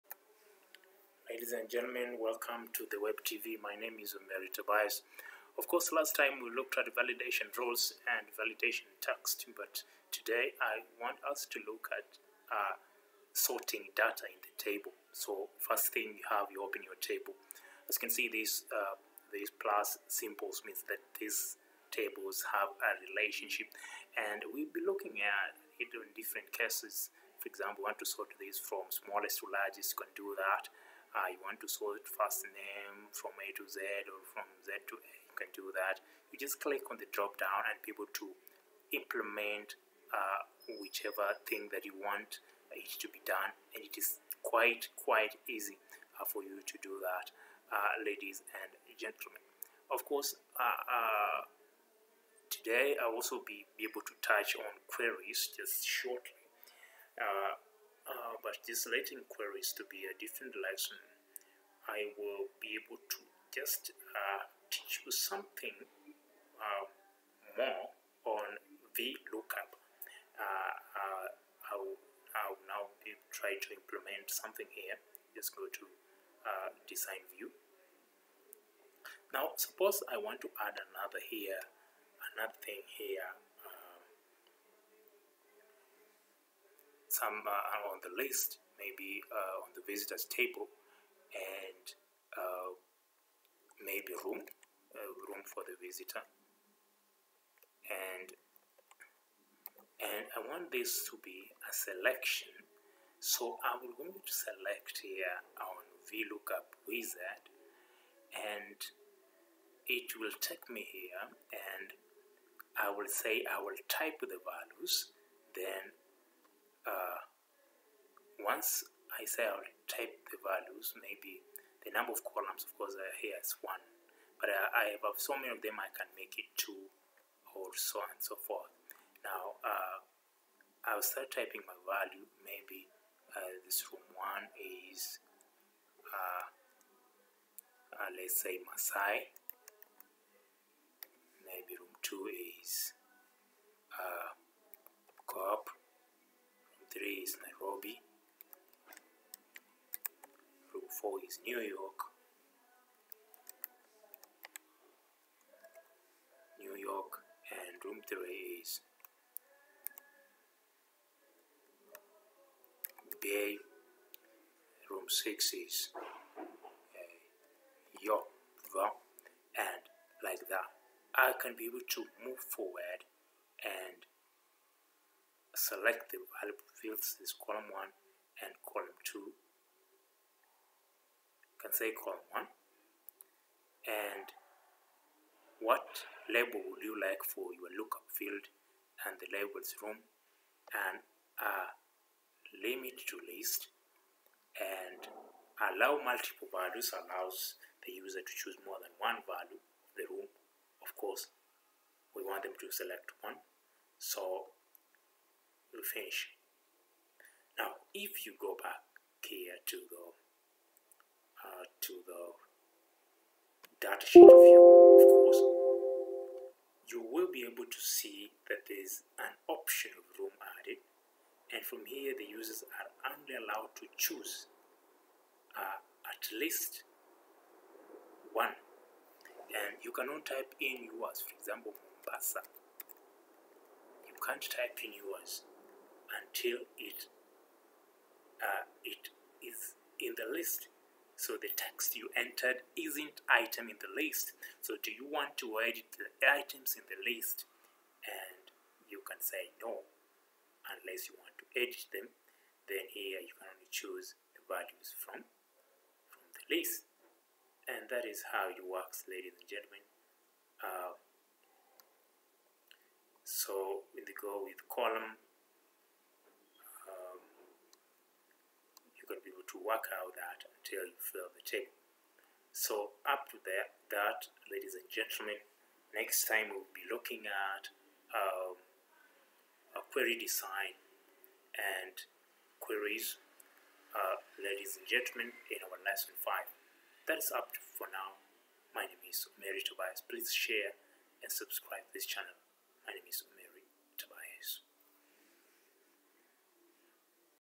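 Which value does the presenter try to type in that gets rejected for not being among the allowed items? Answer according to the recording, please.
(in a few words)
Mombasa.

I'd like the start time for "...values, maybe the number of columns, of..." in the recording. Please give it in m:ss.
2:00.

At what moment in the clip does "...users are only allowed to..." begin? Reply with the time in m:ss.
3:42.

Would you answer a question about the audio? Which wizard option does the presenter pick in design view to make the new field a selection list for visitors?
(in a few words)
Lookup Wizard.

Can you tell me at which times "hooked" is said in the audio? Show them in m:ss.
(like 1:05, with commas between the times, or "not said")
not said.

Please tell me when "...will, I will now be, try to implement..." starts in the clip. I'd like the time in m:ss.
1:11.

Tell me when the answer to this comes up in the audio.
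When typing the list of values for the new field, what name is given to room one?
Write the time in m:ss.
2:18.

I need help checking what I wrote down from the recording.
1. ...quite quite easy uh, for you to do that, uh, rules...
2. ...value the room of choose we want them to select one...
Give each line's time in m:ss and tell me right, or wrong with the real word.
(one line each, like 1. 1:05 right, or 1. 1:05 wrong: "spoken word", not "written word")
1. 0:44 wrong: "ladies", not "rules"
2. 3:19 wrong: "course", not "choose".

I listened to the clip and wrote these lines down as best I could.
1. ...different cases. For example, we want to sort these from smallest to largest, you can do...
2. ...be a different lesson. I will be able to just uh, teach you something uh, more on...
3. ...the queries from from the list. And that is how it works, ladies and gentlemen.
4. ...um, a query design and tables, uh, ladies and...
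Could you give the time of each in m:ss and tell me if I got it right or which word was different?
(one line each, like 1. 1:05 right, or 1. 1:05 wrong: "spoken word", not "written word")
1. 0:26 right
2. 0:59 right
3. 4:14 wrong: "values", not "queries"
4. 4:38 wrong: "queries", not "tables".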